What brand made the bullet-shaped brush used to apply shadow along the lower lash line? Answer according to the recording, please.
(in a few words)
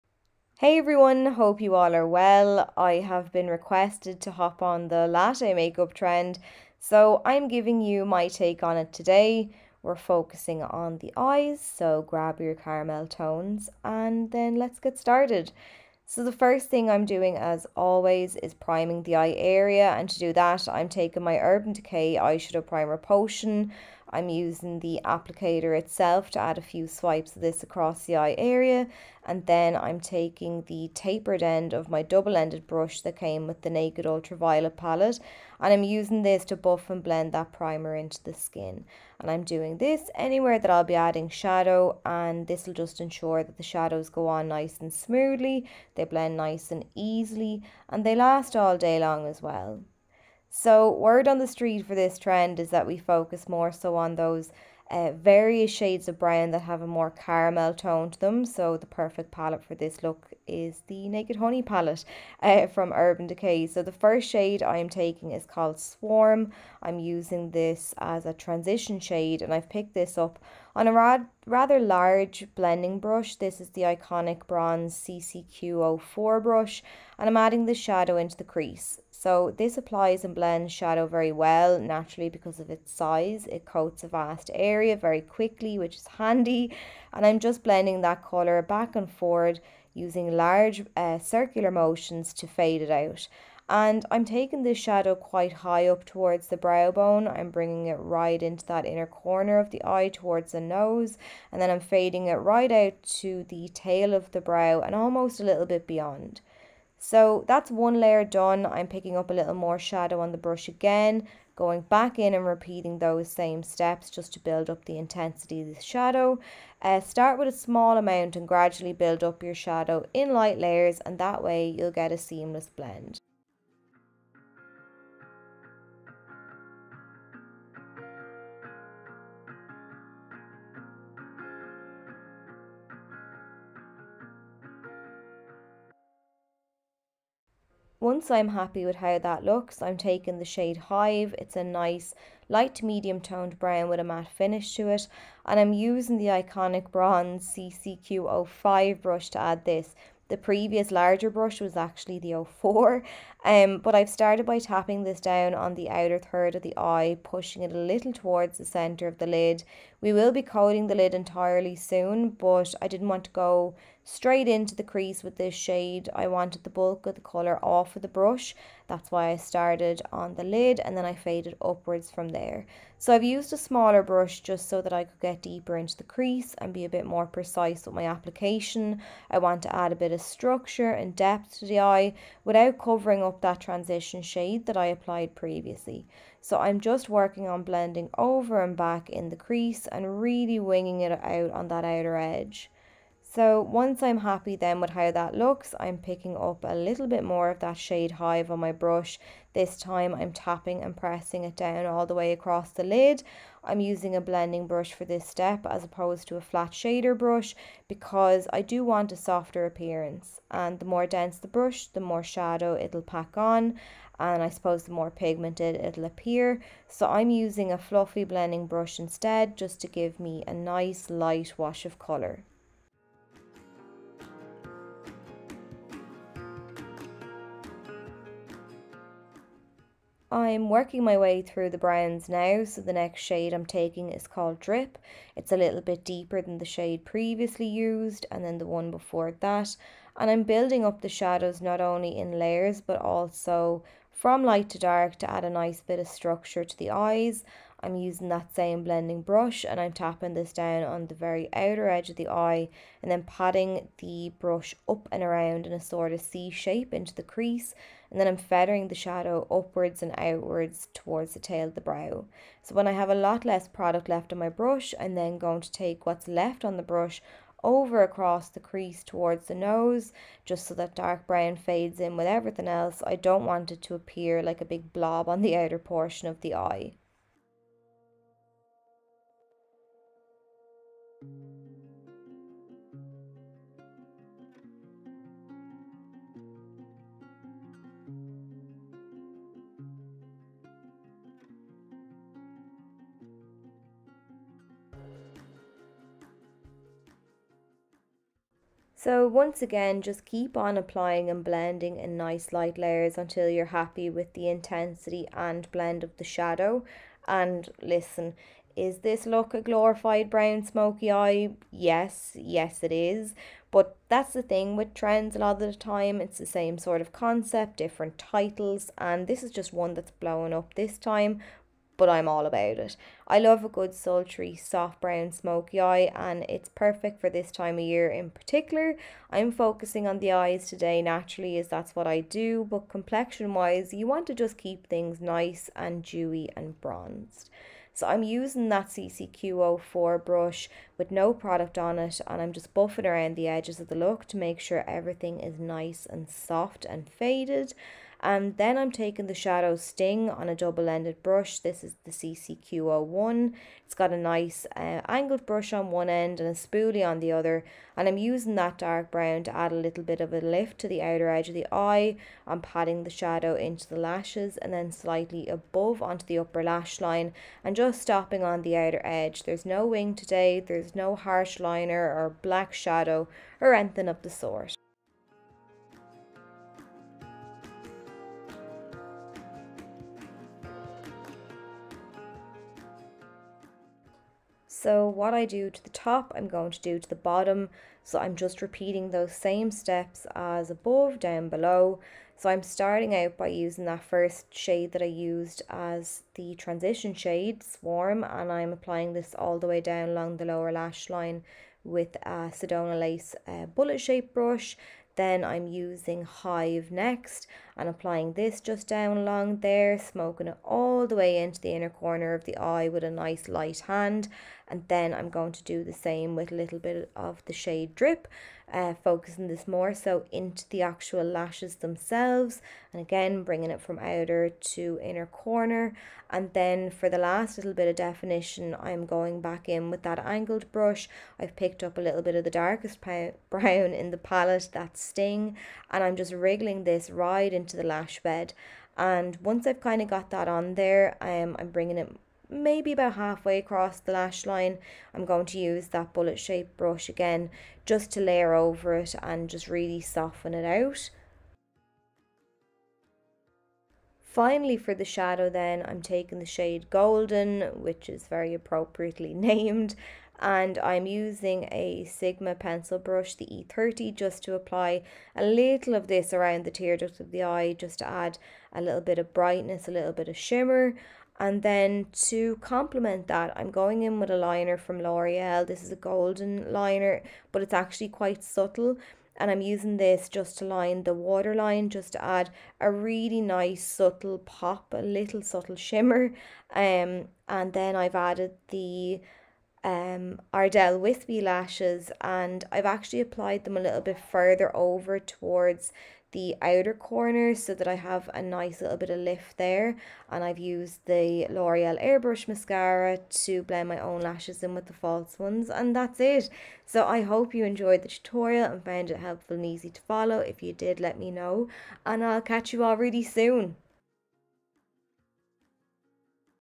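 Sedona Lace.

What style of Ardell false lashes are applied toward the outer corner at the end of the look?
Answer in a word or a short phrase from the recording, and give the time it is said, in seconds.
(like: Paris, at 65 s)
Wispy, at 490 s.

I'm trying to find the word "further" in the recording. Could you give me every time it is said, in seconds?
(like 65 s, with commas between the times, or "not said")
494 s.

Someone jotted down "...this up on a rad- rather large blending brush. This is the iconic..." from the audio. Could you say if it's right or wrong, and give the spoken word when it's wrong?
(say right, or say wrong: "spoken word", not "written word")
right.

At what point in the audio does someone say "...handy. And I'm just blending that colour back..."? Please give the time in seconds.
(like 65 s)
86 s.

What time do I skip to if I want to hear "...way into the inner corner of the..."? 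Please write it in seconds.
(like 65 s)
411 s.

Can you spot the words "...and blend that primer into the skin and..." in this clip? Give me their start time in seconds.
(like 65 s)
36 s.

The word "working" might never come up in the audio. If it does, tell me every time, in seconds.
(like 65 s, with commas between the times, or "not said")
187 s, 230 s.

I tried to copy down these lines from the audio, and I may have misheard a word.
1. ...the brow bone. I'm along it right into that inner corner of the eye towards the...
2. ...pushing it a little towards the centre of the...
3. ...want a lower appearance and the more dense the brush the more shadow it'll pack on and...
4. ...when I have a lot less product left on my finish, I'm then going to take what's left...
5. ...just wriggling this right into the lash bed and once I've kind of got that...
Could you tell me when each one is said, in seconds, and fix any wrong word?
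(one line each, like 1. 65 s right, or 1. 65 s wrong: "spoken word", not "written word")
1. 96 s wrong: "bringing", not "along"
2. 157 s right
3. 208 s wrong: "softer", not "lower"
4. 262 s wrong: "brush", not "finish"
5. 436 s right.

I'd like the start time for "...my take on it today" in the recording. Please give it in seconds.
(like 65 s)
8 s.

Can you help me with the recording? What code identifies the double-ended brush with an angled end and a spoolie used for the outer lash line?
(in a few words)
CCQ01.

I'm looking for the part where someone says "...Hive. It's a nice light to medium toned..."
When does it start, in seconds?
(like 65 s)
140 s.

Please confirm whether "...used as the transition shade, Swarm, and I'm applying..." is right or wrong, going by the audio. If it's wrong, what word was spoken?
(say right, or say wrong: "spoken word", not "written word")
right.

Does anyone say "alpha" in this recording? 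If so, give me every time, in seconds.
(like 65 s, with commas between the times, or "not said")
not said.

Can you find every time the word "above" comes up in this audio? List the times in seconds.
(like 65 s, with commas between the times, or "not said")
365 s, 390 s.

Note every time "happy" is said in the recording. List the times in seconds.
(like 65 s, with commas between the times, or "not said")
138 s, 194 s, 303 s.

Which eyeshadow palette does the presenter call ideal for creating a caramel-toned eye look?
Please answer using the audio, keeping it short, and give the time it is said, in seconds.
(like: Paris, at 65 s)
Naked Honey, at 60 s.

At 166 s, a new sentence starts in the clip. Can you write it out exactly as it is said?
I wanted the bulk of the colour off of the brush.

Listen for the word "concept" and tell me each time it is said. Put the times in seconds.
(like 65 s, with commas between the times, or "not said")
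317 s.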